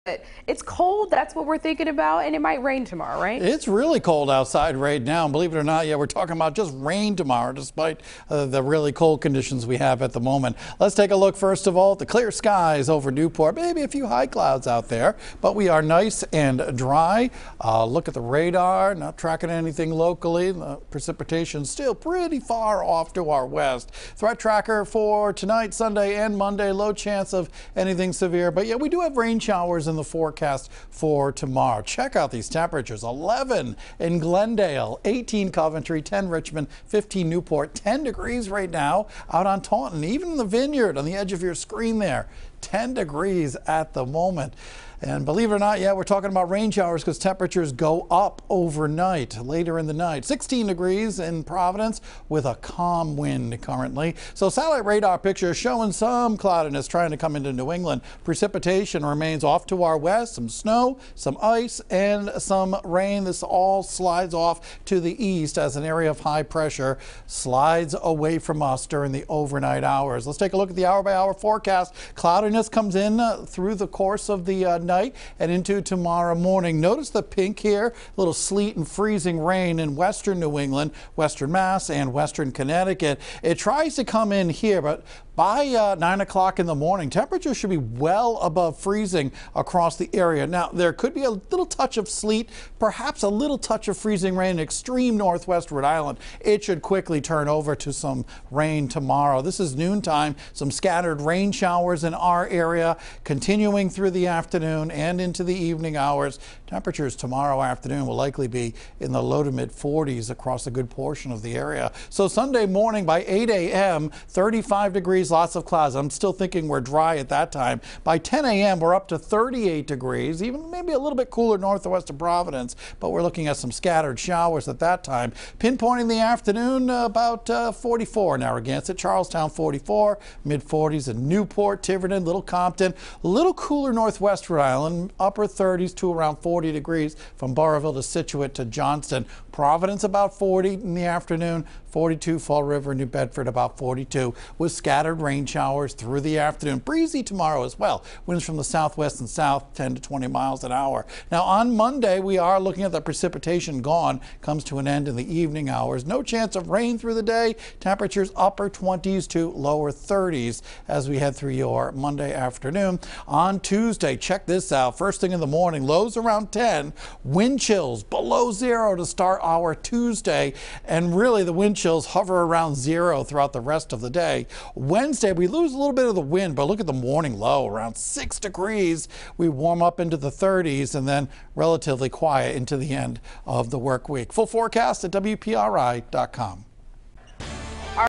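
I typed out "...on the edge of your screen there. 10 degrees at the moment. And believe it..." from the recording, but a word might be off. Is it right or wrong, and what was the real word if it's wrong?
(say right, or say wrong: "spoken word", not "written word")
right.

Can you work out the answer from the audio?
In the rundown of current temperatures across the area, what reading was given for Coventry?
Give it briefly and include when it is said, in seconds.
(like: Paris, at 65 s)
18, at 35 s.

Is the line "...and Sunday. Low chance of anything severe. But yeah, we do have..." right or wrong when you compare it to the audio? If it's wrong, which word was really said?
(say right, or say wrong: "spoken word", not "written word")
wrong: "Monday", not "Sunday".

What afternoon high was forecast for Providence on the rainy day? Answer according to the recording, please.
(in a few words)
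40.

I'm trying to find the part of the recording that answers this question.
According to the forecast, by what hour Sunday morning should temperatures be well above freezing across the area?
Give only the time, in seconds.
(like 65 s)
85 s.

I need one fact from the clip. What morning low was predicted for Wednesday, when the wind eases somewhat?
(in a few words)
6 degrees.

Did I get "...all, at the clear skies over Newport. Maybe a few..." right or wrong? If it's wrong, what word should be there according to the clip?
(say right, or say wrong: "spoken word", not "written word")
right.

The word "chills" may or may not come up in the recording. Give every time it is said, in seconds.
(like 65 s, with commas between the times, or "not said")
167 s, 171 s.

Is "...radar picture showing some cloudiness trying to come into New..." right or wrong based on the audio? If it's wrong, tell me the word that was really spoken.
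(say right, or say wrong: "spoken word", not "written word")
right.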